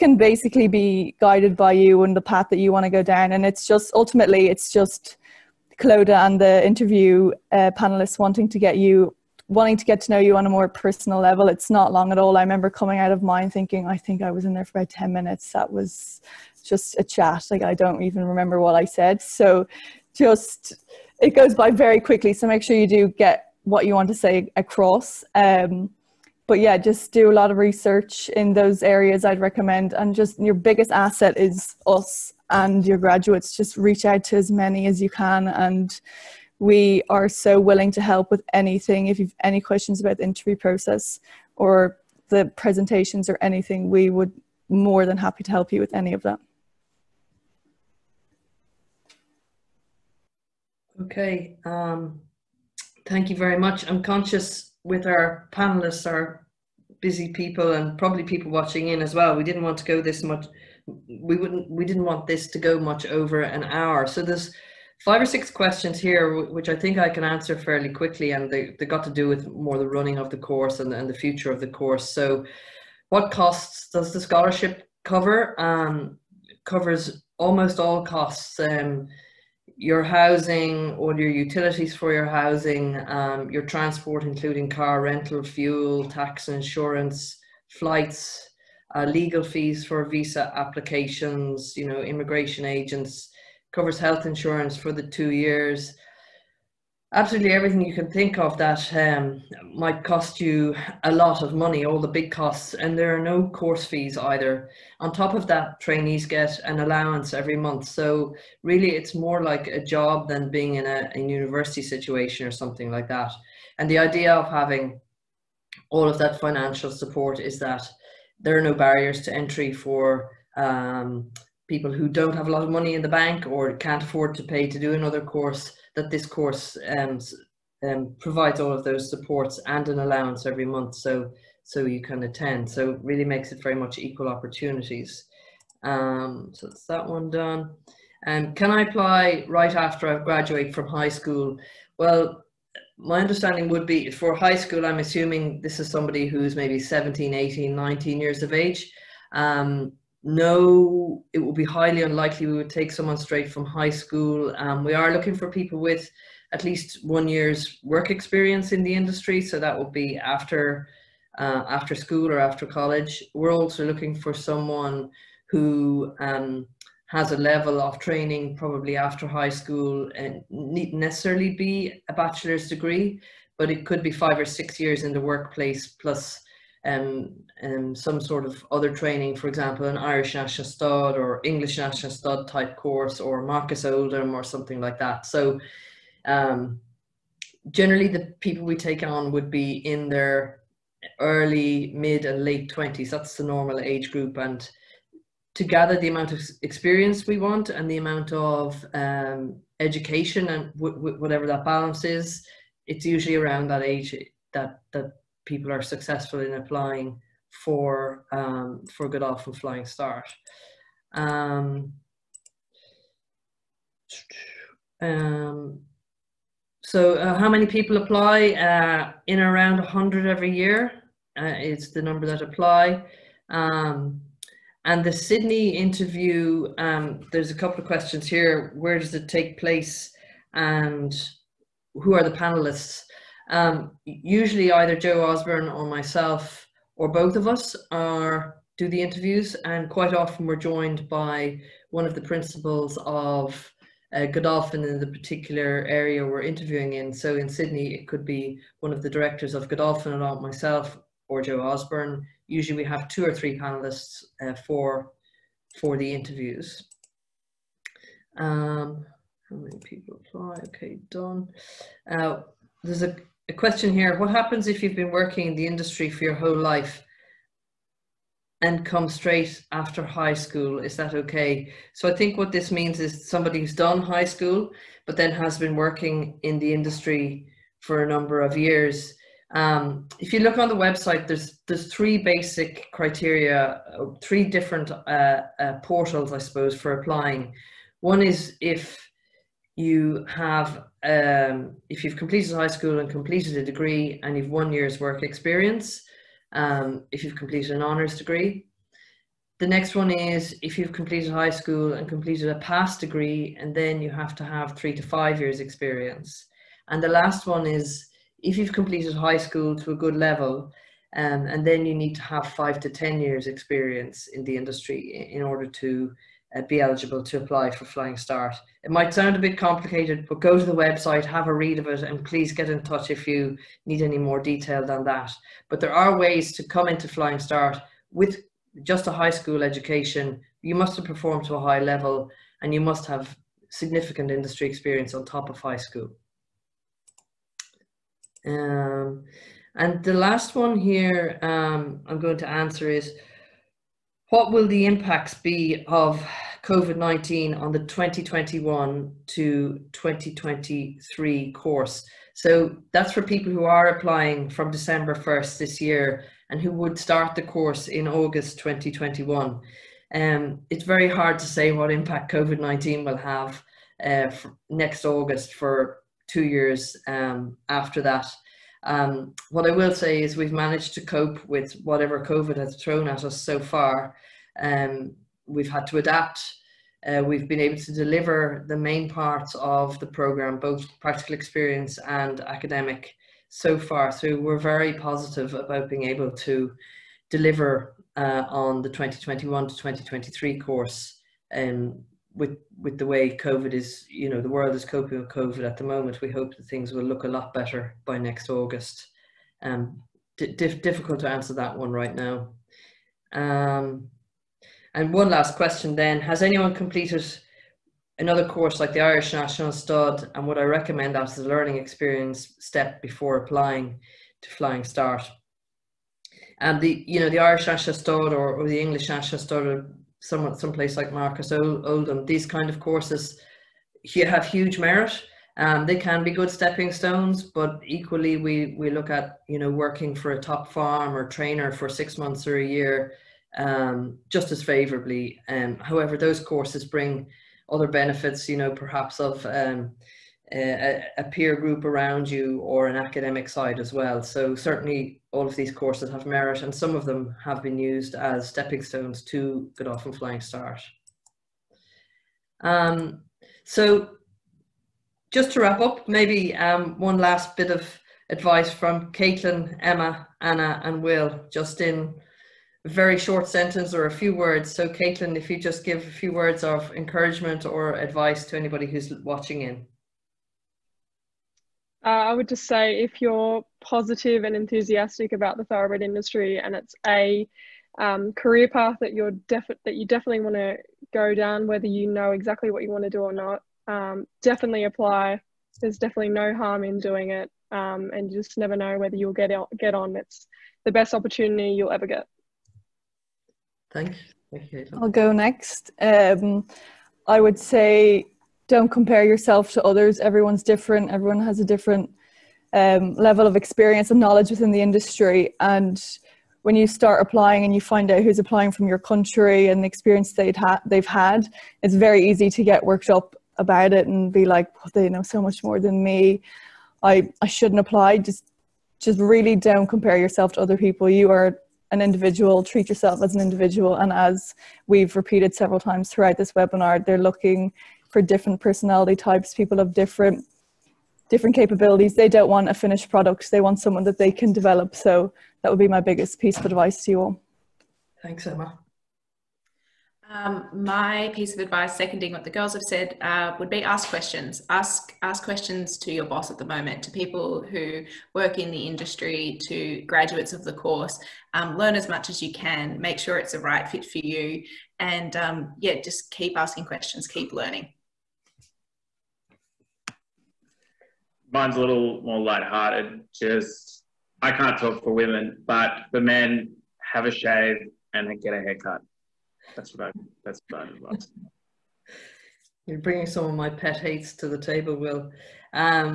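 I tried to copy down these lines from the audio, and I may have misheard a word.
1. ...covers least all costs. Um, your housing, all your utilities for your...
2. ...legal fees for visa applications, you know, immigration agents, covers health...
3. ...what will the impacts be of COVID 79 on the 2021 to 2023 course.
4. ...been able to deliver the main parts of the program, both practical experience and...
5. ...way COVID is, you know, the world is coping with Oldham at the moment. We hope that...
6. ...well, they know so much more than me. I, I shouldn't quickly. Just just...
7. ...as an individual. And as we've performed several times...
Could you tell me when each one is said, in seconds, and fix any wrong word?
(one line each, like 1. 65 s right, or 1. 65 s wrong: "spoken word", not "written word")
1. 76 s wrong: "almost", not "least"
2. 89 s right
3. 344 s wrong: "19", not "79"
4. 377 s right
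5. 393 s wrong: "COVID", not "Oldham"
6. 514 s wrong: "apply", not "quickly"
7. 523 s wrong: "repeated", not "performed".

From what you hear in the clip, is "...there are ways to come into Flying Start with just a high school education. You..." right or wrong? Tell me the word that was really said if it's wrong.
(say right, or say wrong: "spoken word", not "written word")
right.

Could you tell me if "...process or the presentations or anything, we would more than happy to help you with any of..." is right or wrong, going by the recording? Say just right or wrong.
right.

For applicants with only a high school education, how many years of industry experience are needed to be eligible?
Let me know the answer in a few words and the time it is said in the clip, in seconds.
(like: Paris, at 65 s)
5 to 10 years, at 312 s.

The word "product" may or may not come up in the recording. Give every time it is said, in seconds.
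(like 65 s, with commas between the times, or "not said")
533 s.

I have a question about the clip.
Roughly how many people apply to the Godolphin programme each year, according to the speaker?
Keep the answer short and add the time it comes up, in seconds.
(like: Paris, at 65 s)
100, at 219 s.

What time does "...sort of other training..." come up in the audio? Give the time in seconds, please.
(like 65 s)
178 s.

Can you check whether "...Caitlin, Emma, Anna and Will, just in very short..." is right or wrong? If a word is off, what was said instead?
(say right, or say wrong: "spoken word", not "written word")
right.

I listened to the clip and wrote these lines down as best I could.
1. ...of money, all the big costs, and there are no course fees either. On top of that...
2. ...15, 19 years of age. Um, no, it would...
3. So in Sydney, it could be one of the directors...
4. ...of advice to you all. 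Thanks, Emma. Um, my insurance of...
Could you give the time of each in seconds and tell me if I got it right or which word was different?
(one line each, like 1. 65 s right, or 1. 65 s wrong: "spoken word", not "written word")
1. 101 s right
2. 147 s wrong: "18", not "15"
3. 247 s right
4. 536 s wrong: "piece", not "insurance".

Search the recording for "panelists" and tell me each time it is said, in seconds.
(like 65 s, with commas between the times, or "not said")
7 s, 55 s, 232 s, 253 s.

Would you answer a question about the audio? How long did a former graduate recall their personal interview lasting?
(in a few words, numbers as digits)
About 10 minutes.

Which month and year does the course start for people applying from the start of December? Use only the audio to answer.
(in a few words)
August 2021.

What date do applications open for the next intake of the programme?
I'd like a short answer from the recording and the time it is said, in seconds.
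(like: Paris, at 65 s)
December 1st, at 354 s.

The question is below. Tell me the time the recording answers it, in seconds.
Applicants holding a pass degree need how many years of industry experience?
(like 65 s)
304 s.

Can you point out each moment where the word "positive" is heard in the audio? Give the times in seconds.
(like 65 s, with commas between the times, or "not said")
384 s, 473 s.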